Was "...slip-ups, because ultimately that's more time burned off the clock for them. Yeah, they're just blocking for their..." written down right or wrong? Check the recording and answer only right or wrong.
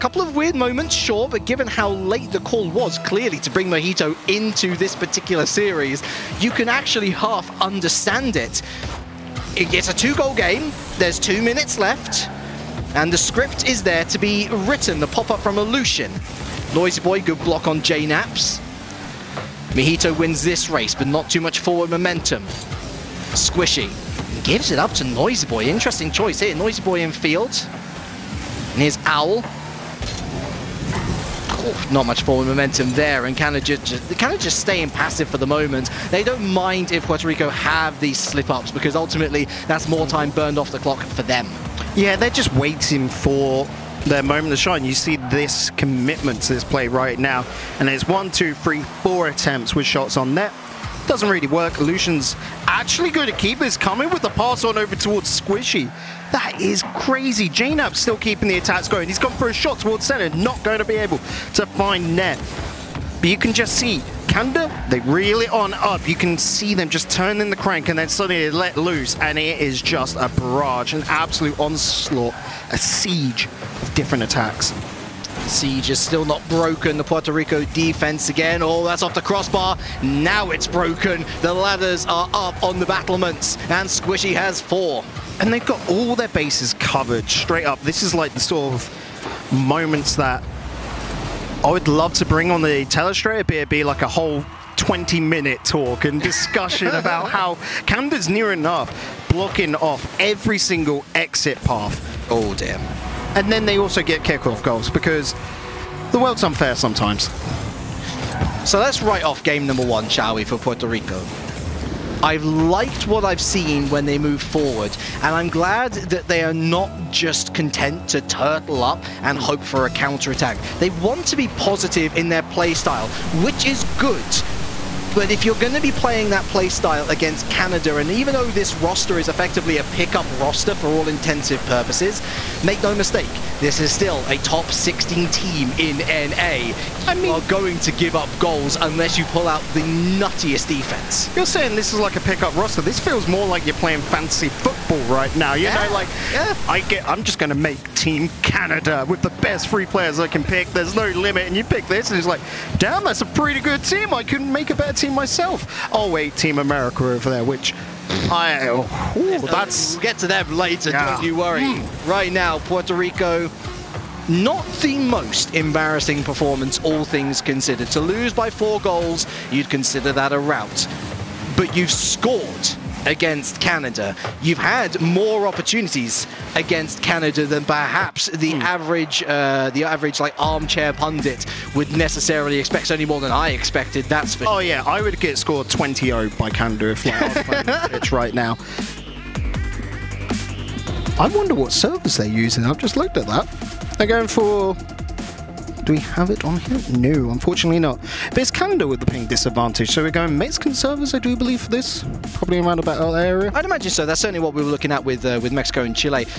wrong.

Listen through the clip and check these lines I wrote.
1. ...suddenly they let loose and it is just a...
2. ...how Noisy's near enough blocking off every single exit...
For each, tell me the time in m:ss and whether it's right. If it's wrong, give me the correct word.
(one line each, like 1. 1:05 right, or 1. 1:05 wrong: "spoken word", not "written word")
1. 1:08 right
2. 1:37 wrong: "Canada", not "Noisy".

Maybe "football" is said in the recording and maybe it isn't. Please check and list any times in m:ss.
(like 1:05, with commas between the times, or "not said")
2:24.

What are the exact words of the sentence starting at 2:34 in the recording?
I couldn't make a better team myself.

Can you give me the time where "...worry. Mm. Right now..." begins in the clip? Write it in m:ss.
2:41.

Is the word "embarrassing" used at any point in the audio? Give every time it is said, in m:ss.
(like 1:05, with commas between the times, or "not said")
2:45.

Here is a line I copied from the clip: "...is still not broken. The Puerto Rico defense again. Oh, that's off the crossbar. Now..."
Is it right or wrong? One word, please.
right.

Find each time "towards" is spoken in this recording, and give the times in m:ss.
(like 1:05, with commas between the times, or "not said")
0:54, 0:59.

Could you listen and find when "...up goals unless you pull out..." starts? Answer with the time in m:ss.
2:18.